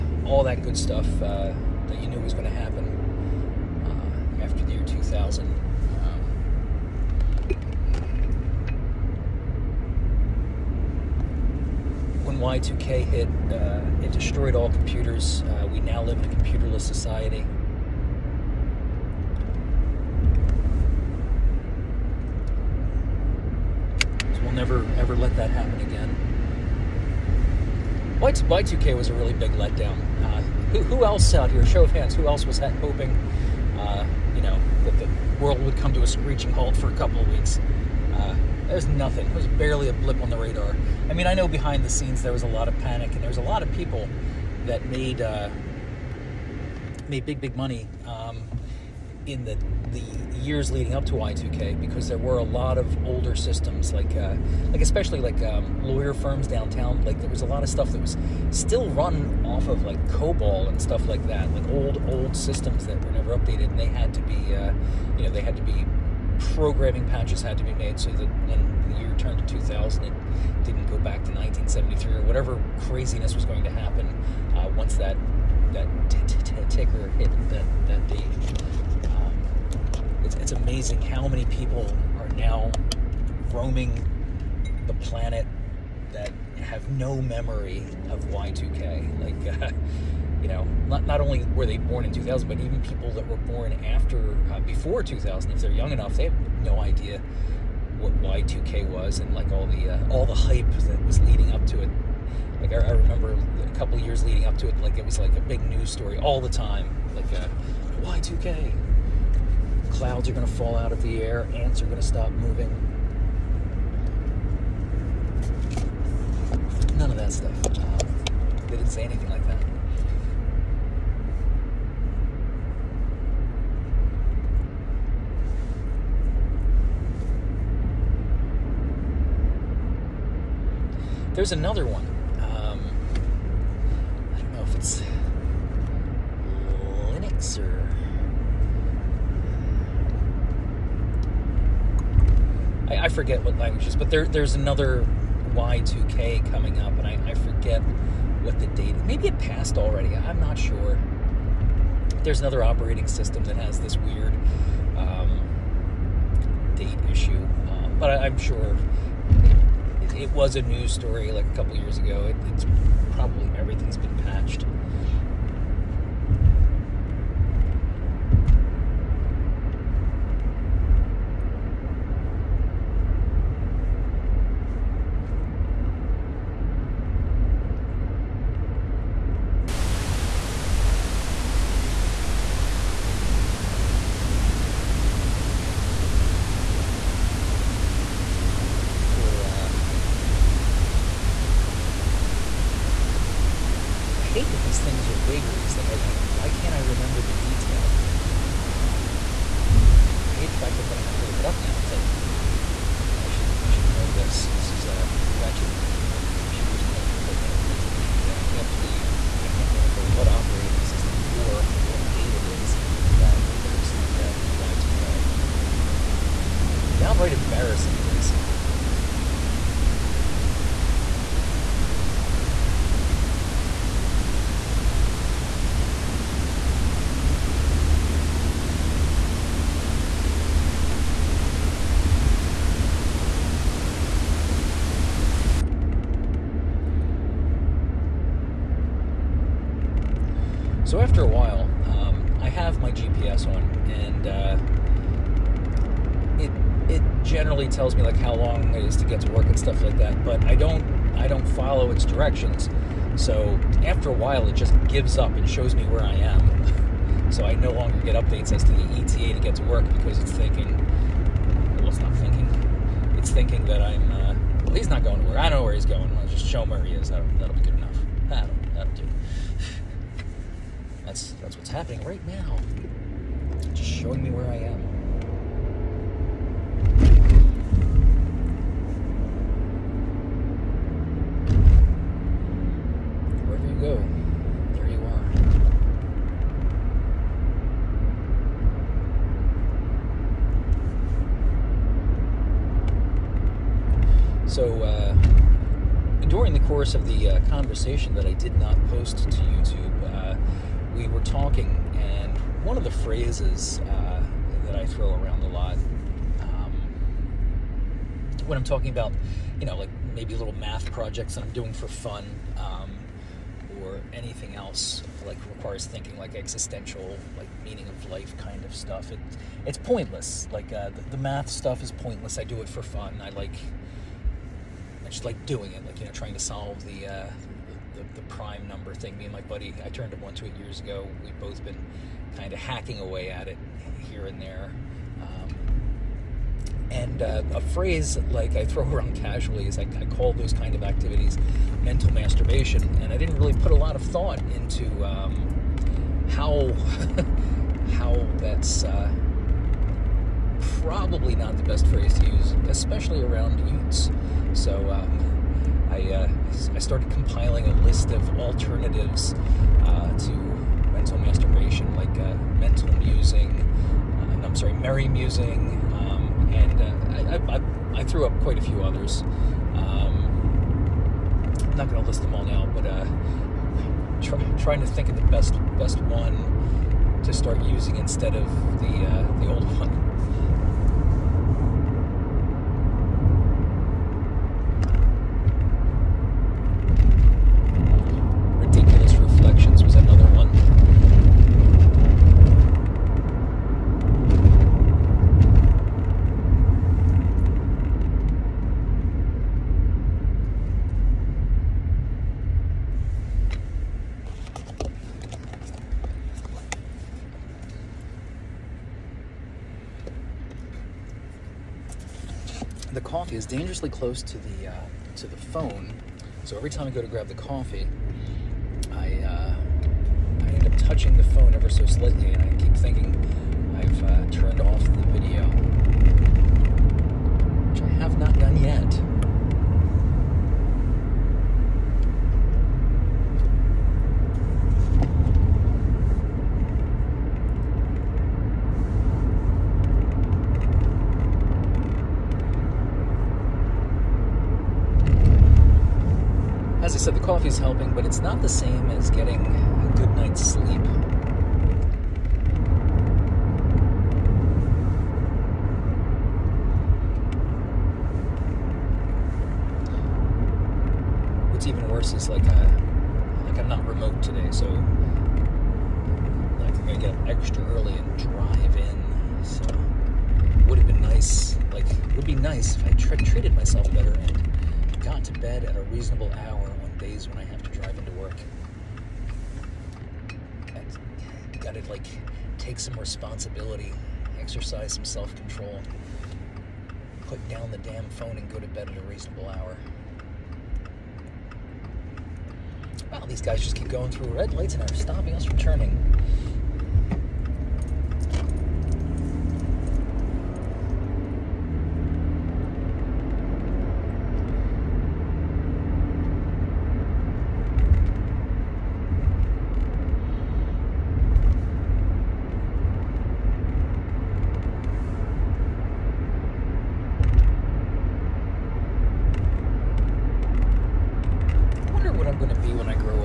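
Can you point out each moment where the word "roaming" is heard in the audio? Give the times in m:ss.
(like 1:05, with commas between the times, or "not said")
1:23.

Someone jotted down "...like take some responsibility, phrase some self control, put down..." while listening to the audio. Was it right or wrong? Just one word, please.
wrong.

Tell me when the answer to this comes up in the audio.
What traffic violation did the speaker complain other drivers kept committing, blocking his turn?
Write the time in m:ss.
8:13.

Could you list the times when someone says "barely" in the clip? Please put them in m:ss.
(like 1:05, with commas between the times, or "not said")
0:39.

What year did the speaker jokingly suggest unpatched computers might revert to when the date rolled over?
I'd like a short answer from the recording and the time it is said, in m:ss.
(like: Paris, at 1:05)
1973, at 1:11.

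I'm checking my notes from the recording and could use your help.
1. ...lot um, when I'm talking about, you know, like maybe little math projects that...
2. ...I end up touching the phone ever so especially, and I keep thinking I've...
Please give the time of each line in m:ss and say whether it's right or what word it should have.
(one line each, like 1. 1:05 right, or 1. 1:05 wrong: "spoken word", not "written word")
1. 5:05 right
2. 7:00 wrong: "slightly", not "especially".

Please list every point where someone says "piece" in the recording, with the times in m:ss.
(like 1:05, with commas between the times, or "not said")
not said.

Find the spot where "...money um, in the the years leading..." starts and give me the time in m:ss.
0:47.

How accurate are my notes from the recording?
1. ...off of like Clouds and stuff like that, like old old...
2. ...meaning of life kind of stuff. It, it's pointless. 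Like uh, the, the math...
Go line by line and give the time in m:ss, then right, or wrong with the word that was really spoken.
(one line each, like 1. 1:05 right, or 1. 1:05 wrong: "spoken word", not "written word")
1. 0:59 wrong: "COBOL", not "Clouds"
2. 5:17 right.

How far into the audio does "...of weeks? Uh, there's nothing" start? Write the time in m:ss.
0:37.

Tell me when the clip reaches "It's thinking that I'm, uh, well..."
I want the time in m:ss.
4:23.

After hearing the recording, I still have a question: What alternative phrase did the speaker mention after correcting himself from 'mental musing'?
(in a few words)
merry musing.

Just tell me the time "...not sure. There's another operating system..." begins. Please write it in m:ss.
2:30.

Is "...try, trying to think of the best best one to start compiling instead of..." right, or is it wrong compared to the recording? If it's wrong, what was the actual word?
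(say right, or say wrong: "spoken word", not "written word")
wrong: "using", not "compiling".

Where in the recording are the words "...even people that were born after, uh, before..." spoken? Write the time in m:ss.
1:32.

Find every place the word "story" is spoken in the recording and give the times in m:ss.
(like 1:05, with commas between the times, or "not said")
1:45, 2:40.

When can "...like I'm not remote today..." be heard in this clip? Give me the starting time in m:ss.
7:43.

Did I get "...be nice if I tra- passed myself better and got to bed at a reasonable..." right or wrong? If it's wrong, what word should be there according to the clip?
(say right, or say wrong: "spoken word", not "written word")
wrong: "treated", not "passed".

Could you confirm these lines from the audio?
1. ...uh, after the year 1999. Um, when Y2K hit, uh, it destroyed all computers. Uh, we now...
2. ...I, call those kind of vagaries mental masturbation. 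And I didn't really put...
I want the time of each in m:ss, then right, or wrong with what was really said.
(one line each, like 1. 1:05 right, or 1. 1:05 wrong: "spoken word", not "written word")
1. 0:03 wrong: "2000", not "1999"
2. 5:39 wrong: "activities", not "vagaries".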